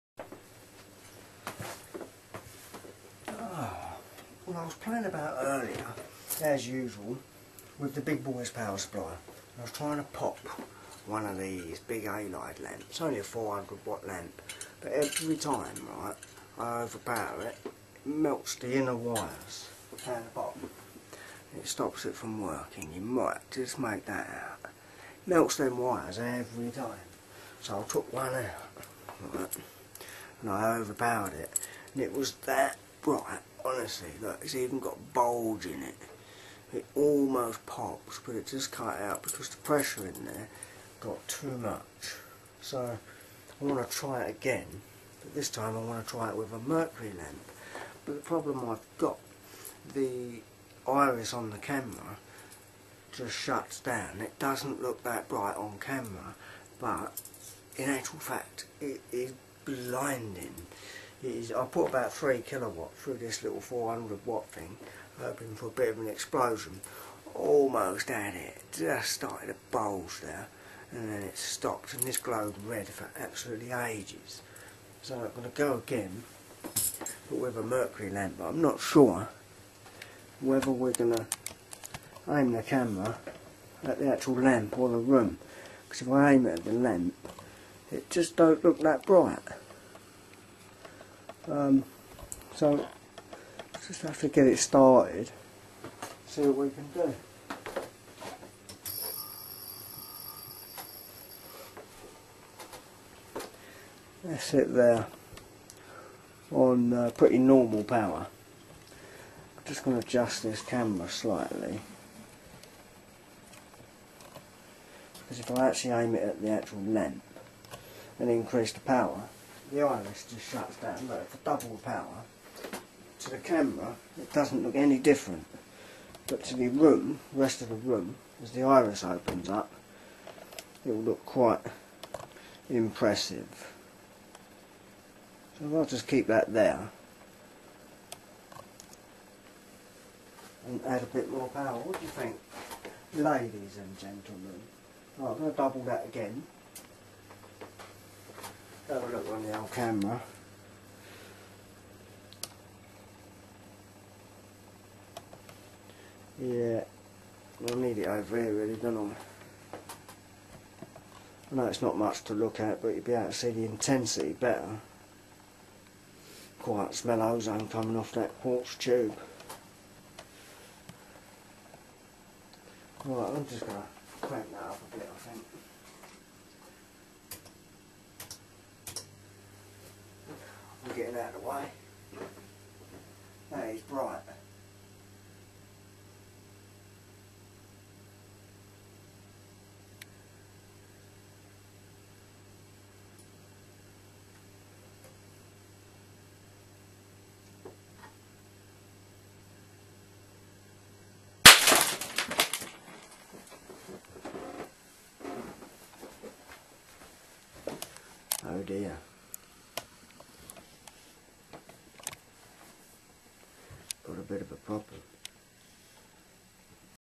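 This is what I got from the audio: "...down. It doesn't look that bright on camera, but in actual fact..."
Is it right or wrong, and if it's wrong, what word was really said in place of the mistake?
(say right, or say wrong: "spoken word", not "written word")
right.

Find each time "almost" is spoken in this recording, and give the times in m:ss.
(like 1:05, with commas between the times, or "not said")
0:36, 1:07.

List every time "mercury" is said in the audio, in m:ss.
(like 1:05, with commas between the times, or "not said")
0:46, 1:17.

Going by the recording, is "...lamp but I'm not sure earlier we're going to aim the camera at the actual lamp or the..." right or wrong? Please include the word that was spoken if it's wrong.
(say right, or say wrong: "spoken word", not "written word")
wrong: "whether", not "earlier".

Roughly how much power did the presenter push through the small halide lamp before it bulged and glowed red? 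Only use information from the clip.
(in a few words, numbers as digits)
3 kilowatt.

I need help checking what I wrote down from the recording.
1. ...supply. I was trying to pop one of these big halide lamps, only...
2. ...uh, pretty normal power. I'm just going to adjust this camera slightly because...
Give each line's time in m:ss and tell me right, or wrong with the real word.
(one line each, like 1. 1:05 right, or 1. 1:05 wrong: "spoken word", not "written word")
1. 0:08 right
2. 1:46 right.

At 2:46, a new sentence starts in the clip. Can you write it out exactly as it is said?
Quite smell ozone coming off that quartz tube.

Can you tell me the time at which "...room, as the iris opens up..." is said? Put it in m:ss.
2:07.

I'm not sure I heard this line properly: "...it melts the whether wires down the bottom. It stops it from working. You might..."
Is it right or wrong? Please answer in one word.
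wrong.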